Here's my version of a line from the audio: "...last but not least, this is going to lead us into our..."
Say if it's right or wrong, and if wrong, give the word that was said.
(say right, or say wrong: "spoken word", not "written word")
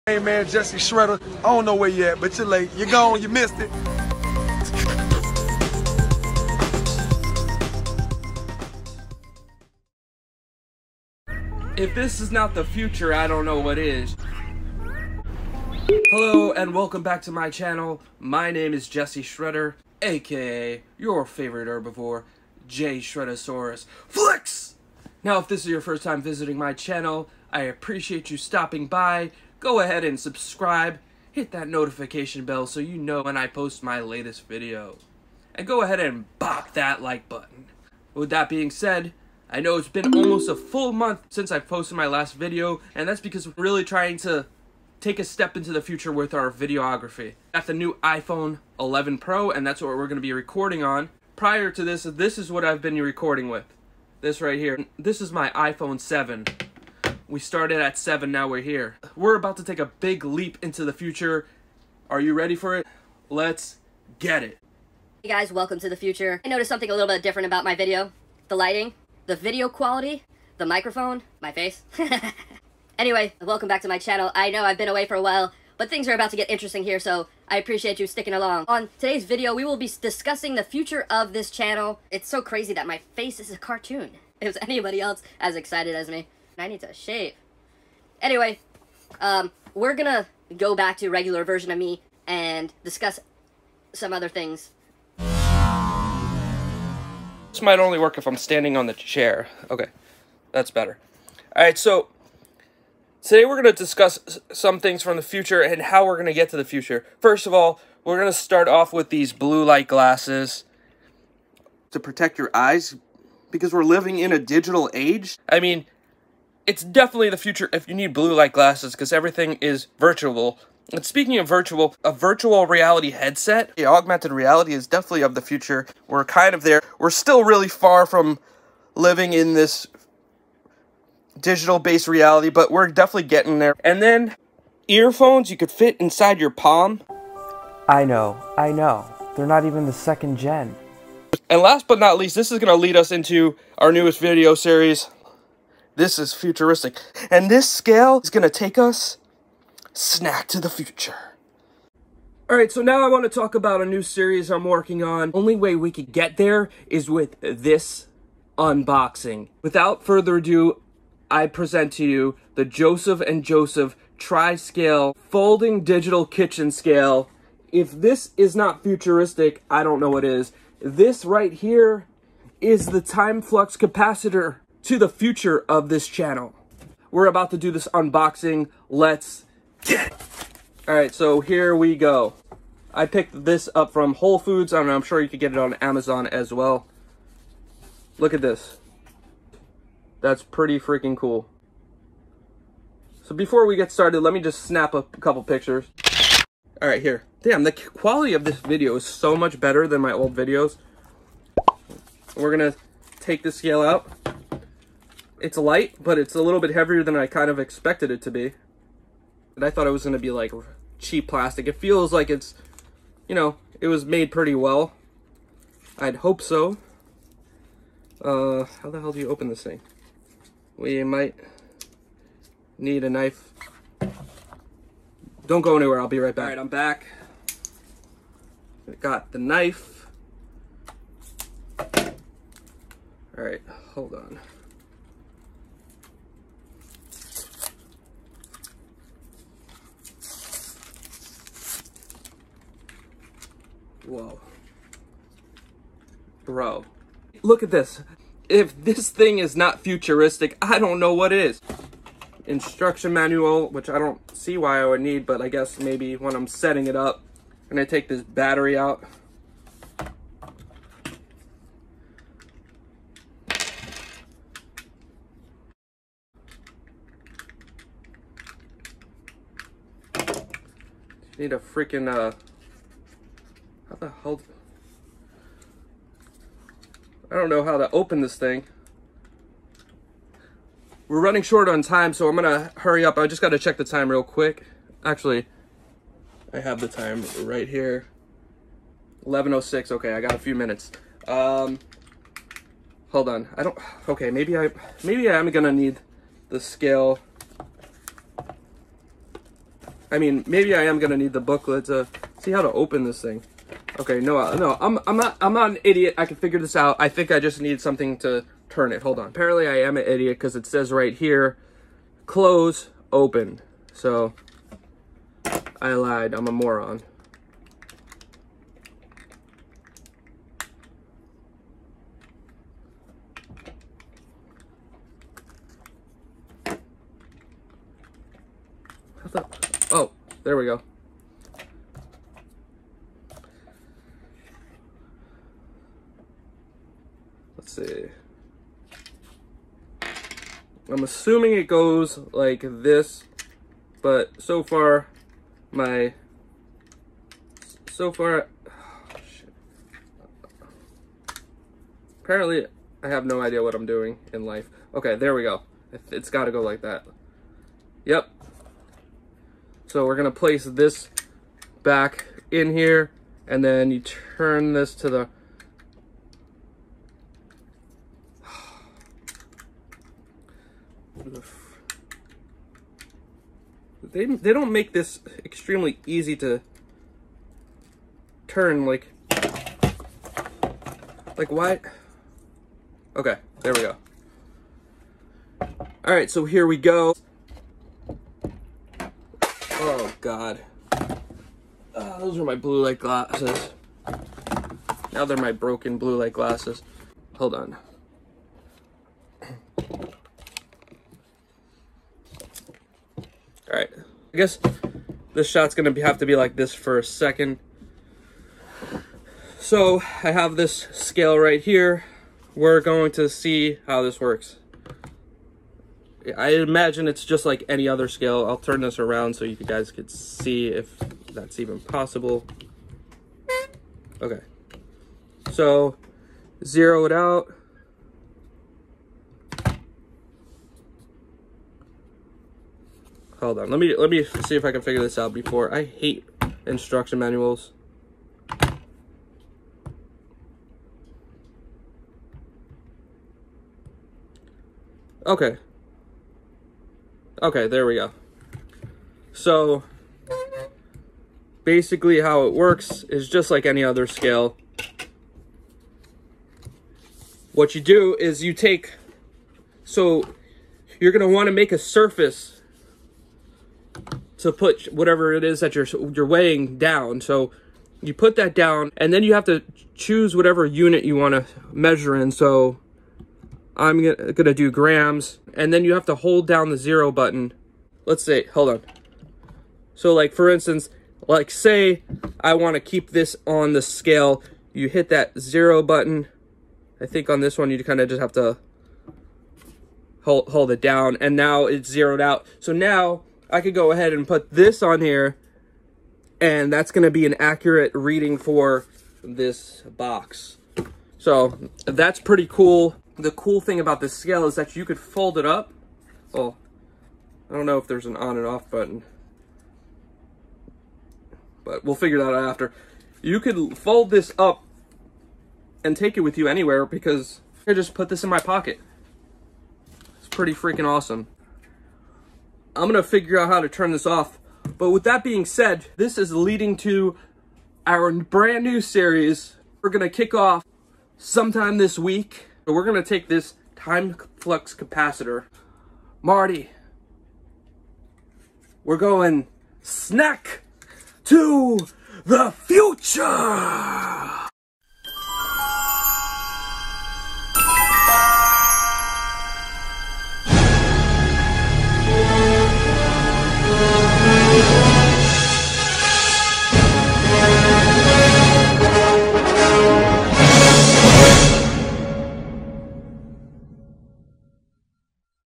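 right.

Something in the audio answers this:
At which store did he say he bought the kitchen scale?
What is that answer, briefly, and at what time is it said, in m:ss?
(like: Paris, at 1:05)
Whole Foods, at 3:04.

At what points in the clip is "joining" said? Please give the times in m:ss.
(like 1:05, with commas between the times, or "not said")
not said.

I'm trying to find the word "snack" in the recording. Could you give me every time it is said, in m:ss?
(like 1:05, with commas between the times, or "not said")
2:29, 8:59.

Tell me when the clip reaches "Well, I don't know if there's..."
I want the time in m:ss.
8:26.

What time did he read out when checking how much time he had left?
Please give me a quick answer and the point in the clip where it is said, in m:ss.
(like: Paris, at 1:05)
11:06, at 4:49.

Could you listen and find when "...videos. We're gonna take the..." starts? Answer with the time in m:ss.
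3:20.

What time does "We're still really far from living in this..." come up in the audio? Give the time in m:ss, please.
2:06.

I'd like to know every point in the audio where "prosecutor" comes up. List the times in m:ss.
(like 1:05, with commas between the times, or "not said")
not said.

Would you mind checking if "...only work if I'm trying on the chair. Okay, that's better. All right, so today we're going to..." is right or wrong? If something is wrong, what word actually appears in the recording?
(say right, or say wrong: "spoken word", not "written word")
wrong: "standing", not "trying".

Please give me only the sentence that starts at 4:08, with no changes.
If this thing is not futuristic, I don't know what is.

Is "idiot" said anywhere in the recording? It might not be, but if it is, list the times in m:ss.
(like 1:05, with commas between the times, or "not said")
5:05, 5:10.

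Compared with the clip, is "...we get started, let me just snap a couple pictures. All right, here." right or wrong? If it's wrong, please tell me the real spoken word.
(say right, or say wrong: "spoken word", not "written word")
right.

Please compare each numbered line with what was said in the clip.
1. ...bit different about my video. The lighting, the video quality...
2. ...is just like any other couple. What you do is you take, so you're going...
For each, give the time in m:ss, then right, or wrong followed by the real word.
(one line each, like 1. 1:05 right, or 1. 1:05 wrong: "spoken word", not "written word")
1. 1:07 right
2. 7:33 wrong: "scale", not "couple".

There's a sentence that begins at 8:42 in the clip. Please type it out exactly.
I'm gonna figure out how to turn this off.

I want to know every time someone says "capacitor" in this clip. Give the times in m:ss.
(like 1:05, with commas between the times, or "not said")
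2:53, 8:54.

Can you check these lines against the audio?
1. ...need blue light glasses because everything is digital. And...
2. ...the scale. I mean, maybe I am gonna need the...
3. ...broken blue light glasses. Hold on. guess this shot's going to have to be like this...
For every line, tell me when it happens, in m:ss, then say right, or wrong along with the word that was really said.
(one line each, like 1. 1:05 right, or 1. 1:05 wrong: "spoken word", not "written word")
1. 1:57 wrong: "virtual", not "digital"
2. 4:56 right
3. 6:35 right.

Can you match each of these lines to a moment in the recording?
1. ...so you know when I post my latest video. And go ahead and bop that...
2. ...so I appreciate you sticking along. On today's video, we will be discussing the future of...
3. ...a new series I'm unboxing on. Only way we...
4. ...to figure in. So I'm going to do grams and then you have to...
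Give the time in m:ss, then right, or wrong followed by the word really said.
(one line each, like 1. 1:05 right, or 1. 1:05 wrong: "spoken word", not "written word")
1. 0:32 right
2. 1:16 right
3. 2:33 wrong: "working", not "unboxing"
4. 7:51 wrong: "measure", not "figure".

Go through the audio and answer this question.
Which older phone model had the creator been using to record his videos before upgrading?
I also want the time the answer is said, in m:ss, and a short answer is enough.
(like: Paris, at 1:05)
iPhone 7, at 0:55.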